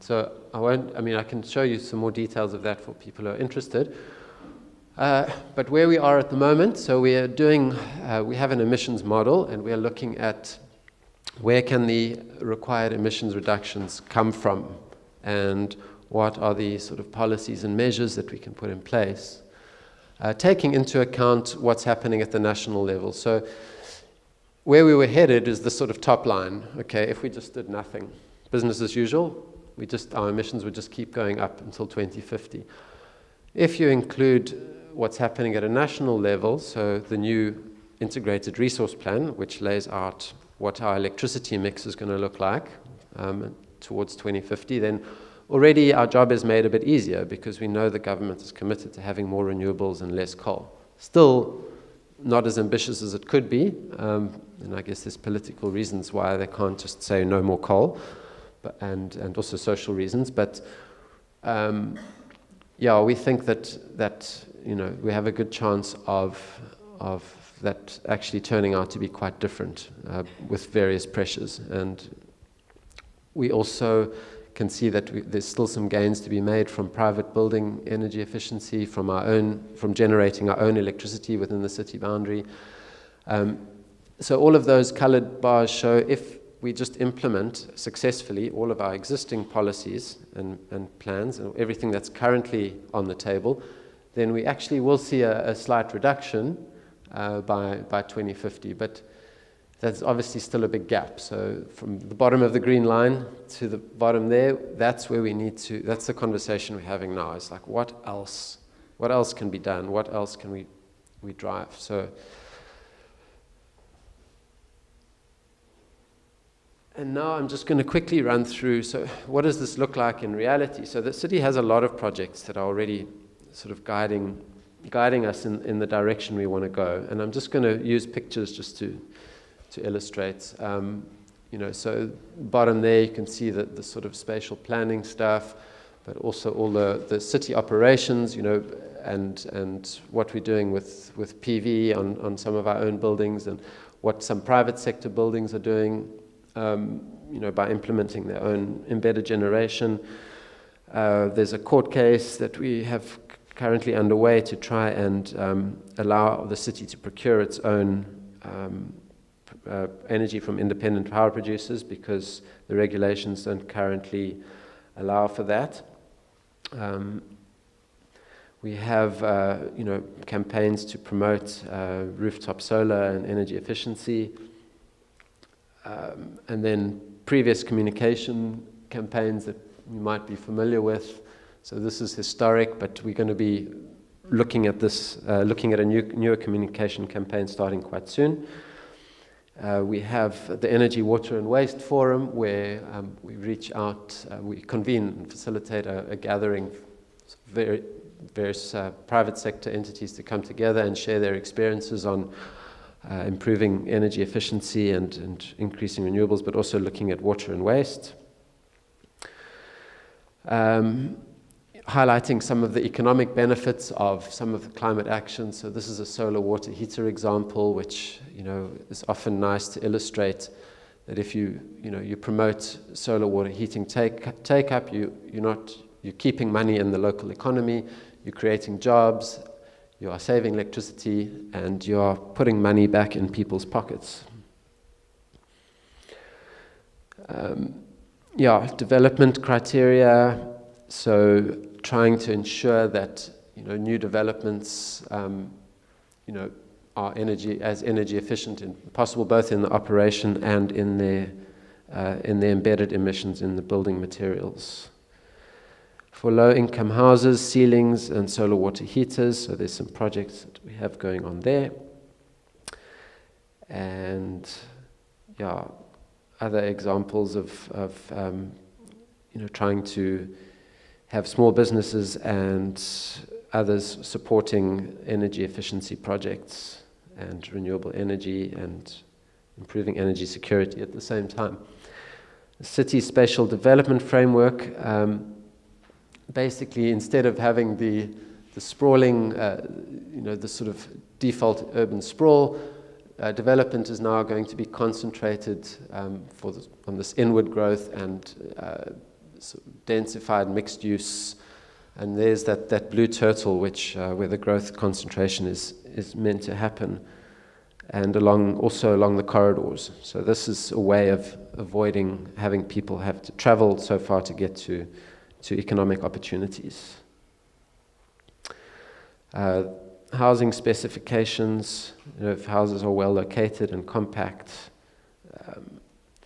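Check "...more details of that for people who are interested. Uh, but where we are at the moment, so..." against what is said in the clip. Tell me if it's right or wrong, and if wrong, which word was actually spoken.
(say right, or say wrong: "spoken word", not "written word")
right.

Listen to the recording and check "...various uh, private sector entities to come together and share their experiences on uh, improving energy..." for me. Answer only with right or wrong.
right.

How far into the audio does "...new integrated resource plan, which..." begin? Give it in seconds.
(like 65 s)
37 s.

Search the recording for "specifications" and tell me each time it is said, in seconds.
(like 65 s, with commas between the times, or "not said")
320 s.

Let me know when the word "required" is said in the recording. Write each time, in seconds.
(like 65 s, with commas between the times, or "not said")
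12 s.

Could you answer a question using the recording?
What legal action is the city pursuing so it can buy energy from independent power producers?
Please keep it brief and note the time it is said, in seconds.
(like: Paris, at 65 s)
A court case, at 151 s.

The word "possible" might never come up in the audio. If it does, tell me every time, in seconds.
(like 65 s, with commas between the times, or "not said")
248 s.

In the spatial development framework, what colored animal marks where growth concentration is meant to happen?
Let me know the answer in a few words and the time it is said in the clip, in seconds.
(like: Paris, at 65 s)
Blue turtle, at 302 s.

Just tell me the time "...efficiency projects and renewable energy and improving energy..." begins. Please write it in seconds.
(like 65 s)
275 s.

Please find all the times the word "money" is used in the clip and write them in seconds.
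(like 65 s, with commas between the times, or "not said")
226 s, 232 s.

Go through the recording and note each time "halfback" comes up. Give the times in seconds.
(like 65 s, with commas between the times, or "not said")
not said.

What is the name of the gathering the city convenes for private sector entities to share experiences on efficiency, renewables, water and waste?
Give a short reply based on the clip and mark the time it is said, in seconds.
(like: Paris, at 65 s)
Energy, Water and Waste Forum, at 190 s.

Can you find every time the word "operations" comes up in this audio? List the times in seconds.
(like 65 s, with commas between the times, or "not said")
137 s, 249 s.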